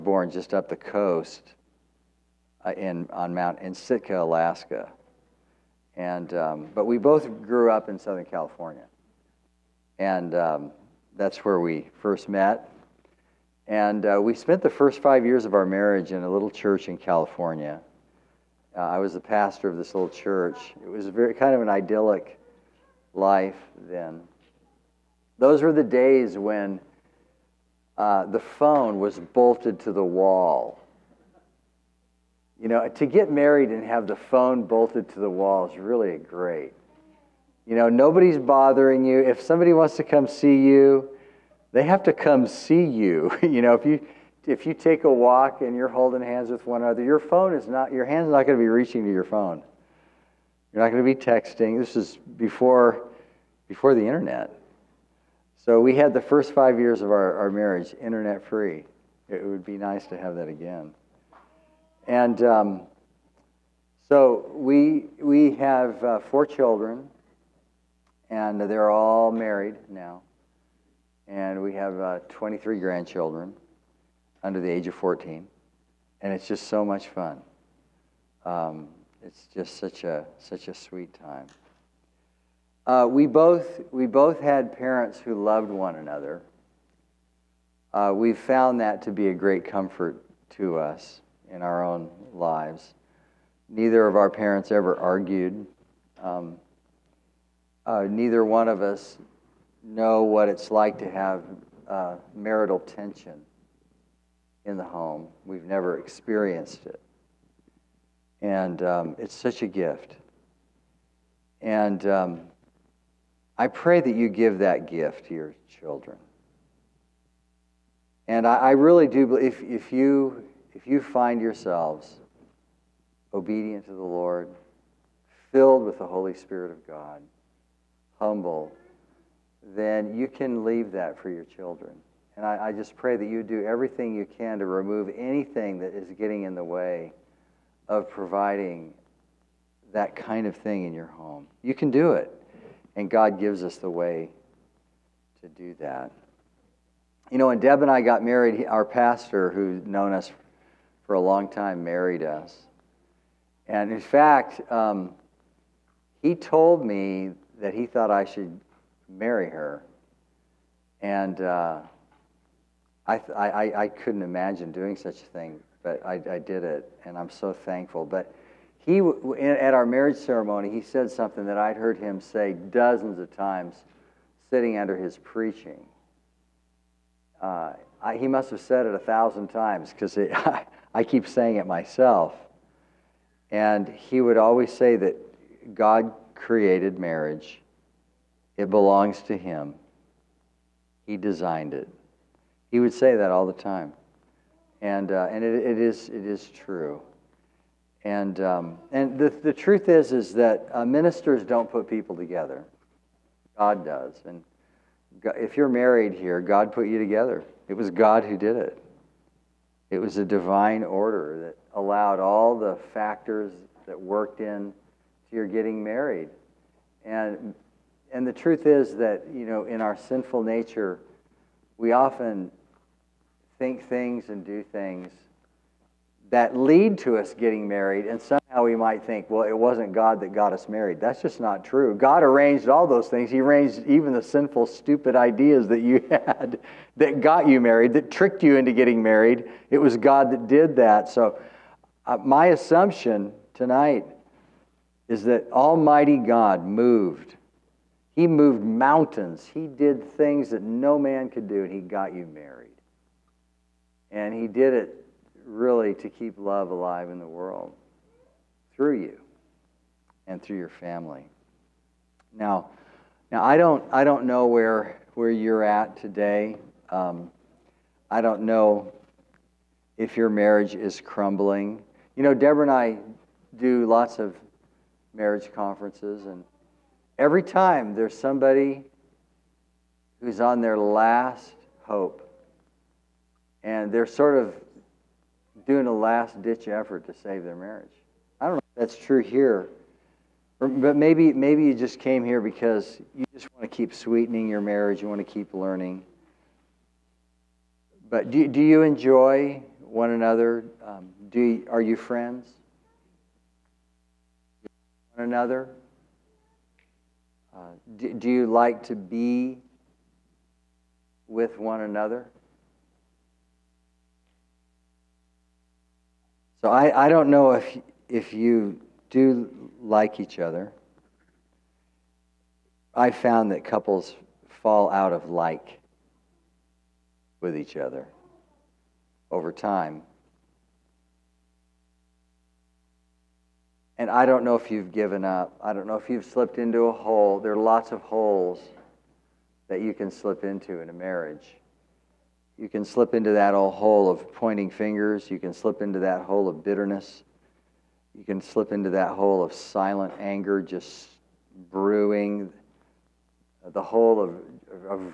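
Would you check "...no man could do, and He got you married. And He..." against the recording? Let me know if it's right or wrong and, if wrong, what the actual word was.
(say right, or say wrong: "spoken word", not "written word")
right.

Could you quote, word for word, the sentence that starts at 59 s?
It would be nice to have that again.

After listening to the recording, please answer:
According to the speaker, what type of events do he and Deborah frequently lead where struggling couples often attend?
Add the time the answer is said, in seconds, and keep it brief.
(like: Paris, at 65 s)
marriage conferences, at 275 s.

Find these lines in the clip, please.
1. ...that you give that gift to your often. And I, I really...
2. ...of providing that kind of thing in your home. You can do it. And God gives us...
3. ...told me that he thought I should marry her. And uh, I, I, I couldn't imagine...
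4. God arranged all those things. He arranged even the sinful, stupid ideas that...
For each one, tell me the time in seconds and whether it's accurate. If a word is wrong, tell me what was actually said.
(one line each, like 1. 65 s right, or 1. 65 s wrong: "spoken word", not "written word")
1. 113 s wrong: "children", not "often"
2. 137 s right
3. 156 s right
4. 231 s right.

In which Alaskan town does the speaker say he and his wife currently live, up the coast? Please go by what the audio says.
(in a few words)
Sitka.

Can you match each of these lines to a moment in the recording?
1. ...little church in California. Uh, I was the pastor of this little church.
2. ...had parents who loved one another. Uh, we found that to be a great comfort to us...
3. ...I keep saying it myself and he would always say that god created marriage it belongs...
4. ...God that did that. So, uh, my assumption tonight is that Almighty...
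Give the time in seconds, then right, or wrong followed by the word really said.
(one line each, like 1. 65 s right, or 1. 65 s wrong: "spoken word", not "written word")
1. 16 s right
2. 84 s right
3. 180 s right
4. 239 s right.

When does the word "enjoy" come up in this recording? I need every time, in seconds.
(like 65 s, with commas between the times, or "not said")
298 s.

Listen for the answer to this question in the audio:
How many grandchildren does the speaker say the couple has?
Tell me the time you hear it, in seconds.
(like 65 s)
72 s.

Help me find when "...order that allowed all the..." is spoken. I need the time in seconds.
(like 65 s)
210 s.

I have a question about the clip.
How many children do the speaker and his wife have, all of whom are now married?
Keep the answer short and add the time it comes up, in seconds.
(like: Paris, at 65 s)
4, at 66 s.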